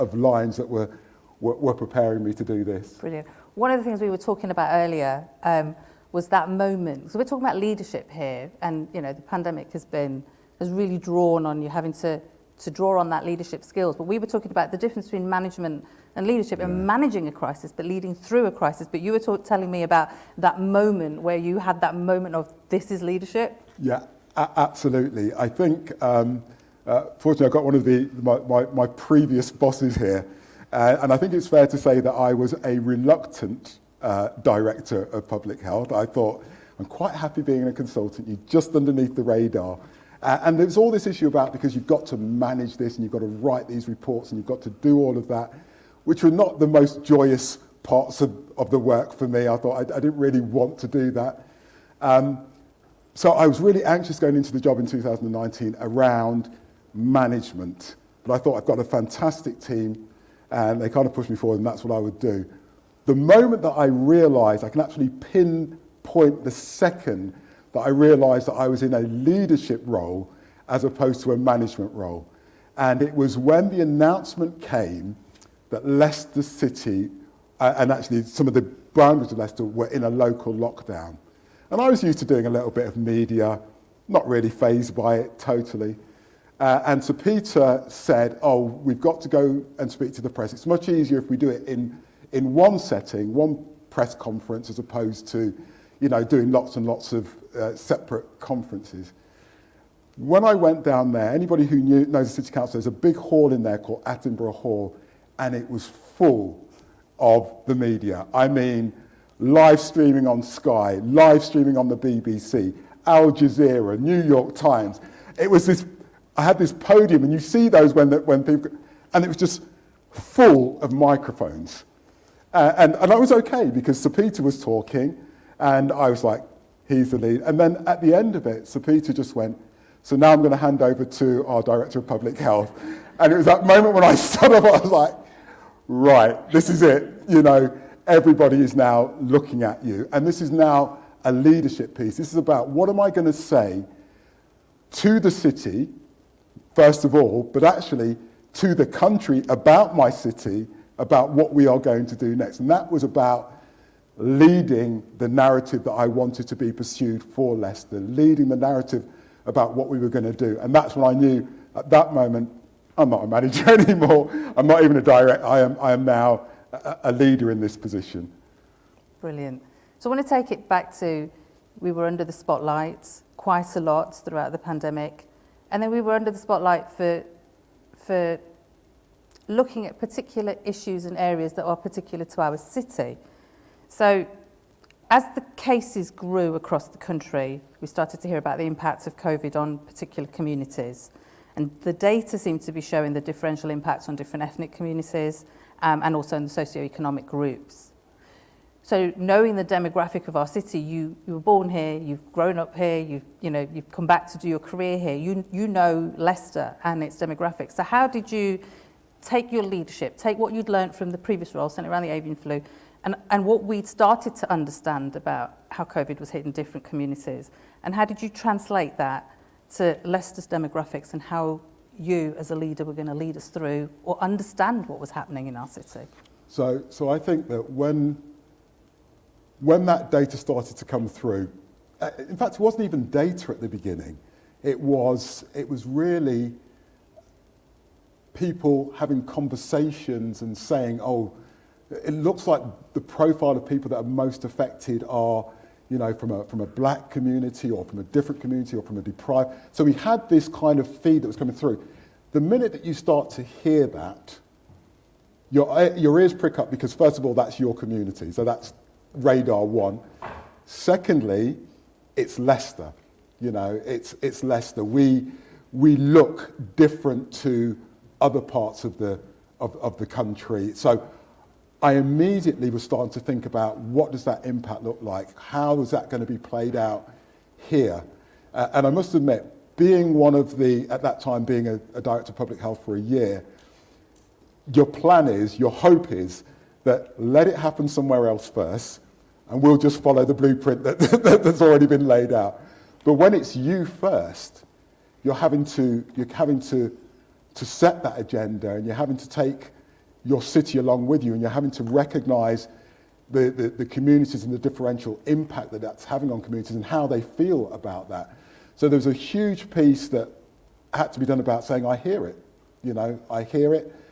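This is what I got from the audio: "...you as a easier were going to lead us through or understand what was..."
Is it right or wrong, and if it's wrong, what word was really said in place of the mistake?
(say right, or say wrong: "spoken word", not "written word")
wrong: "leader", not "easier".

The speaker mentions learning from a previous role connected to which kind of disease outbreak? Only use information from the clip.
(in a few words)
avian flu.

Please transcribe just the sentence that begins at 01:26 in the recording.
Uh, and Sir Peter said, Oh, we've got to go and speak to the press.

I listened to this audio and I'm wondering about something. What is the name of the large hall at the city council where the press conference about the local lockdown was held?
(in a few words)
Attenborough Hall.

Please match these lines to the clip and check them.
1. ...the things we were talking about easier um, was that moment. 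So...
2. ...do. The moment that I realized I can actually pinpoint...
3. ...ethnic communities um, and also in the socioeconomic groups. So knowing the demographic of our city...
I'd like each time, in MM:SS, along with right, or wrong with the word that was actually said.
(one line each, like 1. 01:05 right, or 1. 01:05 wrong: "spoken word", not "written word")
1. 00:03 wrong: "earlier", not "easier"
2. 01:02 right
3. 03:14 right.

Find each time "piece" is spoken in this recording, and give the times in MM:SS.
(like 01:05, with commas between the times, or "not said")
02:21, 05:09.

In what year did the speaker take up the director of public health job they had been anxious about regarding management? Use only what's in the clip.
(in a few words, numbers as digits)
2019.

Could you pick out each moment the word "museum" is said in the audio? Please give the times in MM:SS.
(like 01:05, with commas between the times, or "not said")
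not said.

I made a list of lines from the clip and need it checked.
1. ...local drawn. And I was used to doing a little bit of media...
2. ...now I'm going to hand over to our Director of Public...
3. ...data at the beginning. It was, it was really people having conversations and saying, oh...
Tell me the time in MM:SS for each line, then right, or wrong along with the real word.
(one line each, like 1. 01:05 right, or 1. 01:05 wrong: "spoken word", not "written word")
1. 01:20 wrong: "lockdown", not "drawn"
2. 02:10 right
3. 03:53 right.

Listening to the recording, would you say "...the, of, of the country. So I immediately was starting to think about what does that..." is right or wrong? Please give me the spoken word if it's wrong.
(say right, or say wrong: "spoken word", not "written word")
right.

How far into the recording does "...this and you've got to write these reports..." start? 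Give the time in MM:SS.
00:42.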